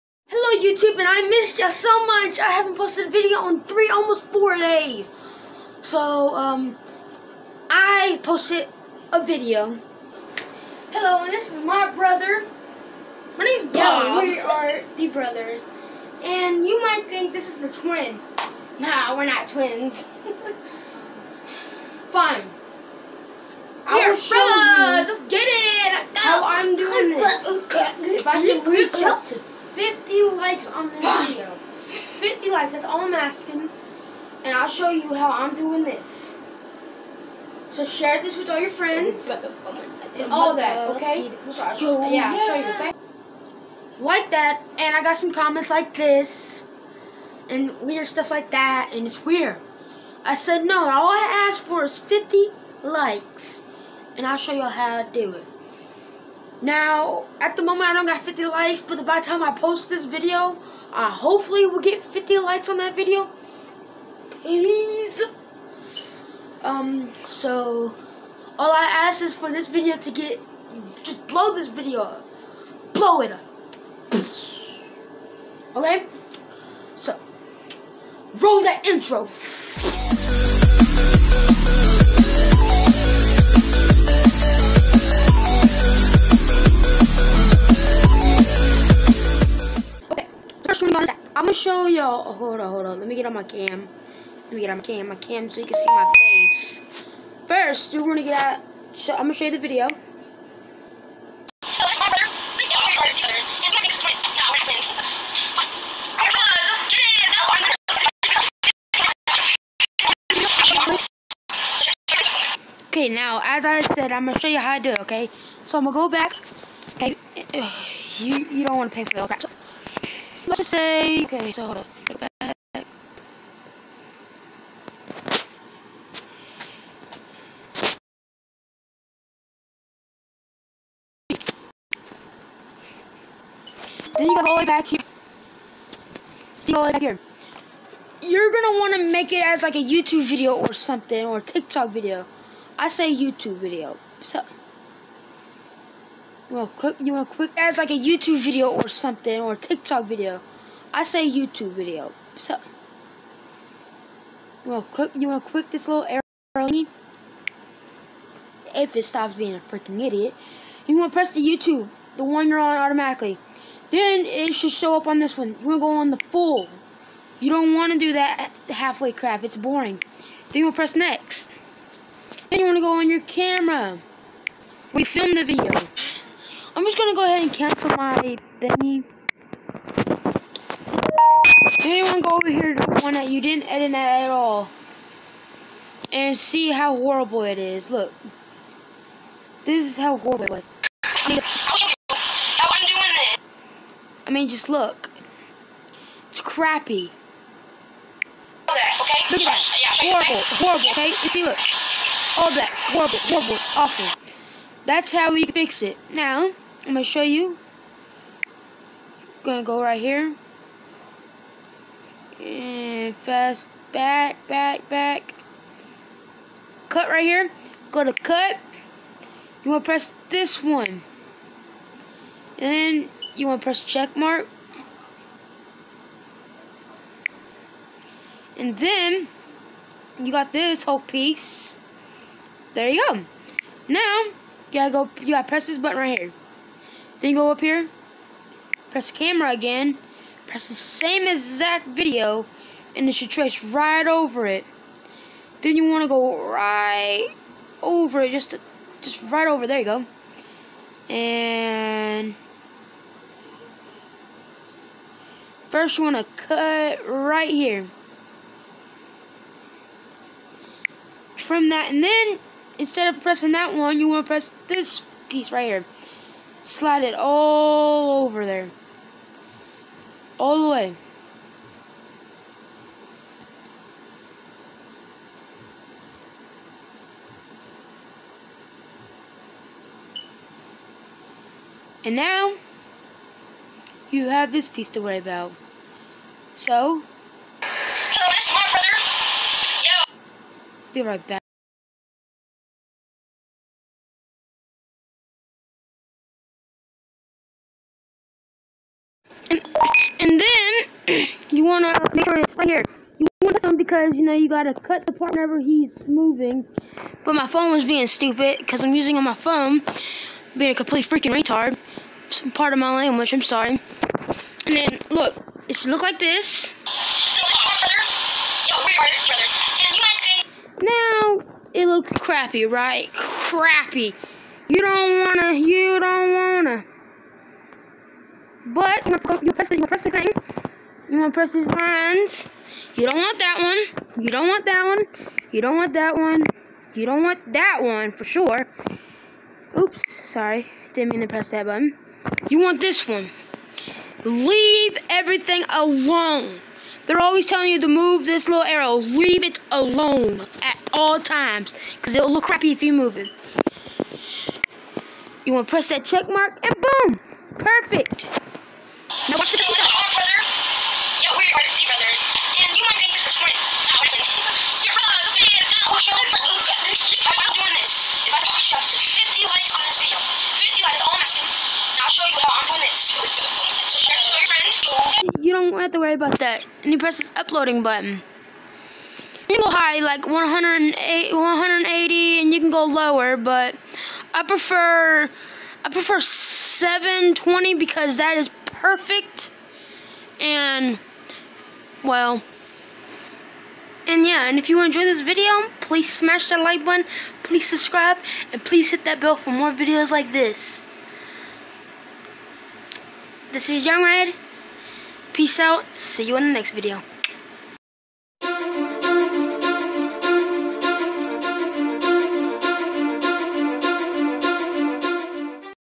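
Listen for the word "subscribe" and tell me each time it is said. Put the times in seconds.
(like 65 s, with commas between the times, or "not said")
397 s.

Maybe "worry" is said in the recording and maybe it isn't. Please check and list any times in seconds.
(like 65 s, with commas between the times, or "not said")
285 s, 375 s.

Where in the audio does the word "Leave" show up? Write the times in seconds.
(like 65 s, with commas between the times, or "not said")
344 s, 348 s.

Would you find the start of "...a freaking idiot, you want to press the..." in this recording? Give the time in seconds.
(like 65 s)
159 s.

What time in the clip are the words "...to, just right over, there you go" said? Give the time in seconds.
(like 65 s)
248 s.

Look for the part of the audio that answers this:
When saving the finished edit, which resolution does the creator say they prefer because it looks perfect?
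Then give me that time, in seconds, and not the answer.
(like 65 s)
386 s.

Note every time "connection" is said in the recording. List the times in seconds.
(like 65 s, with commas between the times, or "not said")
not said.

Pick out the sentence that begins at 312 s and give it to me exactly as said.
Some part of my language, I'm sorry.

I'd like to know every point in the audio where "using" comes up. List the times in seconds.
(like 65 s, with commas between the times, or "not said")
308 s.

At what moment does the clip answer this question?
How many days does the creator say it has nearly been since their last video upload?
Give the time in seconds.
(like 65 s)
4 s.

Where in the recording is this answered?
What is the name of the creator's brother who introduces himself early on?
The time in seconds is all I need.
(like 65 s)
13 s.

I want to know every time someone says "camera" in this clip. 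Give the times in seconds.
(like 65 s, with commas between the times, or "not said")
173 s, 239 s.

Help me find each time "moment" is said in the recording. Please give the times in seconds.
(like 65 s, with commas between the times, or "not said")
57 s.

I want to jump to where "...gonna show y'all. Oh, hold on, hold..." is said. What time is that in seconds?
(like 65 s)
91 s.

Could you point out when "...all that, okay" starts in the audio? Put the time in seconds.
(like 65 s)
40 s.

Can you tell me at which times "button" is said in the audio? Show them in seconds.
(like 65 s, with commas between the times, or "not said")
235 s, 341 s, 377 s, 396 s.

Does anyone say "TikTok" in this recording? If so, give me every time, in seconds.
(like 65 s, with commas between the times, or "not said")
141 s, 149 s.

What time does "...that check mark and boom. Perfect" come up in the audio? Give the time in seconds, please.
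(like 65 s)
355 s.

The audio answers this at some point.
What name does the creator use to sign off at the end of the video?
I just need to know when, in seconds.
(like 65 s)
403 s.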